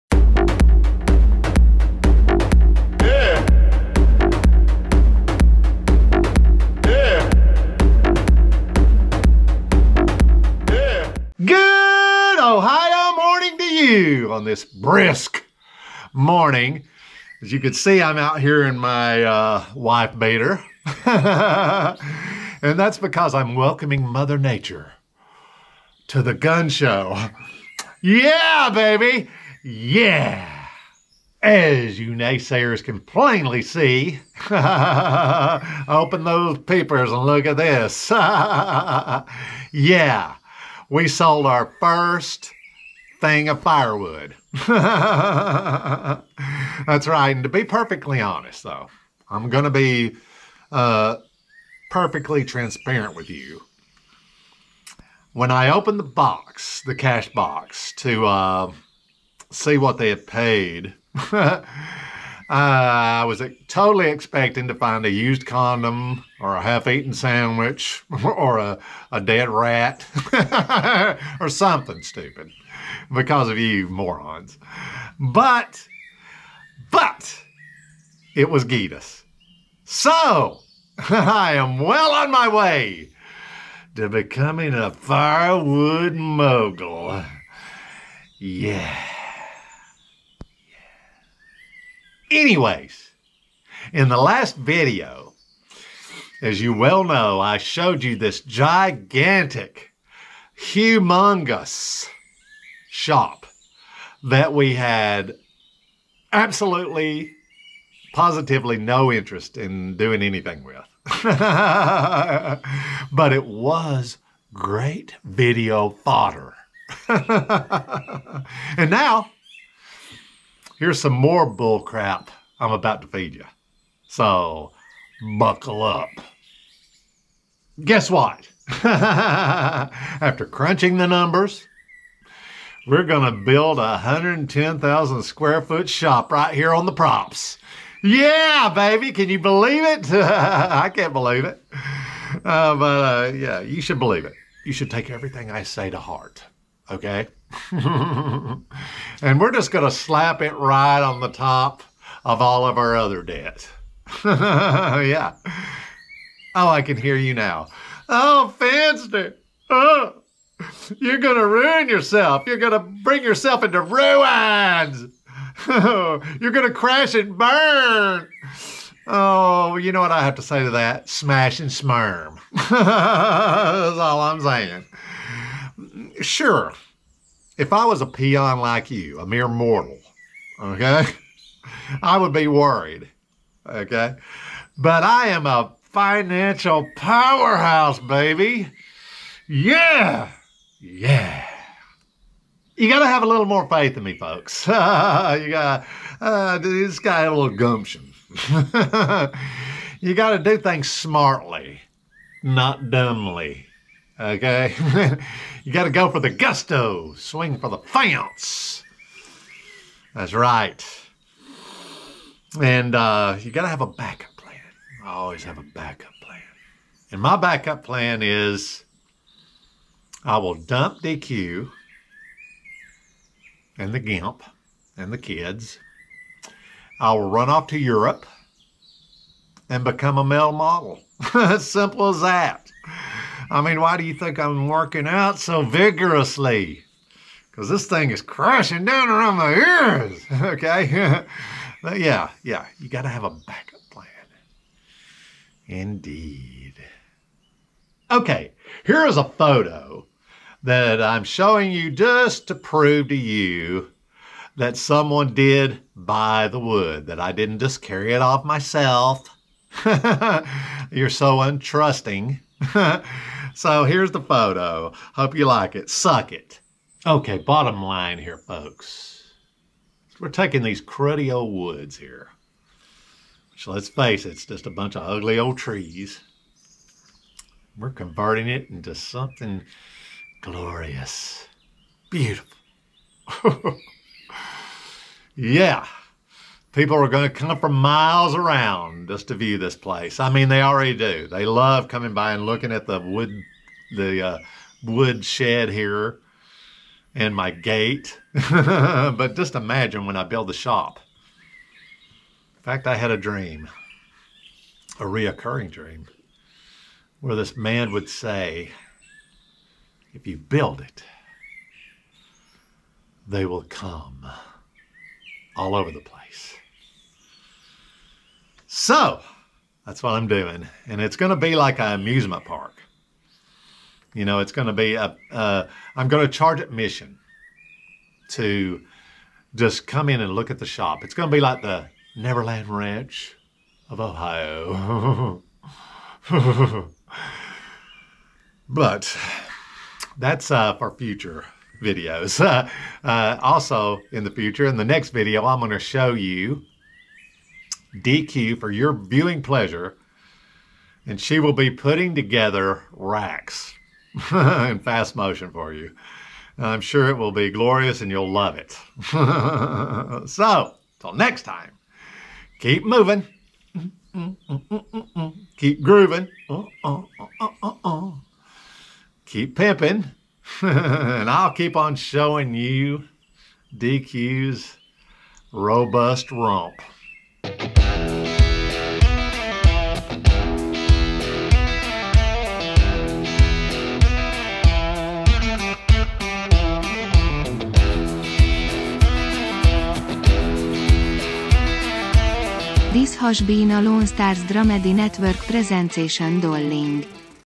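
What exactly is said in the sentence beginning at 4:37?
We're converting it into something glorious, beautiful.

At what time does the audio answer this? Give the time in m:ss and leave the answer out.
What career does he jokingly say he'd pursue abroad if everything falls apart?
3:50.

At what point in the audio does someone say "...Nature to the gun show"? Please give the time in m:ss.
0:24.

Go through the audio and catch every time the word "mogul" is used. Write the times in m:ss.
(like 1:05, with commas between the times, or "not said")
1:26.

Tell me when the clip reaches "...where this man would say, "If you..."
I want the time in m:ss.
5:07.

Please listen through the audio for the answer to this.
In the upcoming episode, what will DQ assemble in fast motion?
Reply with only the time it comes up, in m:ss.
5:52.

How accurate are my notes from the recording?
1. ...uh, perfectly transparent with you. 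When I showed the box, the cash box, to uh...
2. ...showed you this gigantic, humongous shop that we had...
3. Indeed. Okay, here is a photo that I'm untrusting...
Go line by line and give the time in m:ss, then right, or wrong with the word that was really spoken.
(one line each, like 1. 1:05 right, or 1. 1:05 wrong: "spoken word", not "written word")
1. 0:50 wrong: "opened", not "showed"
2. 1:37 right
3. 4:05 wrong: "showing", not "untrusting".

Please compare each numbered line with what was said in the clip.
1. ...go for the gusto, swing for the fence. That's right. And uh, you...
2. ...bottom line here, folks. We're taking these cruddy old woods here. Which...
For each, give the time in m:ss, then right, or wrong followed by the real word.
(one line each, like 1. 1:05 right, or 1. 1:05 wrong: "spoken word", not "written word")
1. 3:25 right
2. 4:27 right.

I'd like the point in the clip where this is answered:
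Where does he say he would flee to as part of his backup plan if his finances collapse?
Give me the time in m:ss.
3:47.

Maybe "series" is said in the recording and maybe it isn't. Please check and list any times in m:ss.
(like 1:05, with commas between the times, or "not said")
not said.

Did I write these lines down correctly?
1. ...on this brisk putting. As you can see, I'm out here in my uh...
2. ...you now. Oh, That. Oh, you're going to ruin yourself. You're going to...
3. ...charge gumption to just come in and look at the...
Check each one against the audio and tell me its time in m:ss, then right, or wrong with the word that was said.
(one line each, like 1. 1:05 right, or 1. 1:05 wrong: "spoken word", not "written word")
1. 0:14 wrong: "morning", not "putting"
2. 2:37 wrong: "Fanster", not "That"
3. 5:26 wrong: "admission", not "gumption".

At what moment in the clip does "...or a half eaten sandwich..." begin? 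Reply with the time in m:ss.
1:06.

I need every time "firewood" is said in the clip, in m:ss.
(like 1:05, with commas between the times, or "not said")
0:43, 1:24.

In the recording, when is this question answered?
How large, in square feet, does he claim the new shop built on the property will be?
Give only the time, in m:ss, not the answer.
2:14.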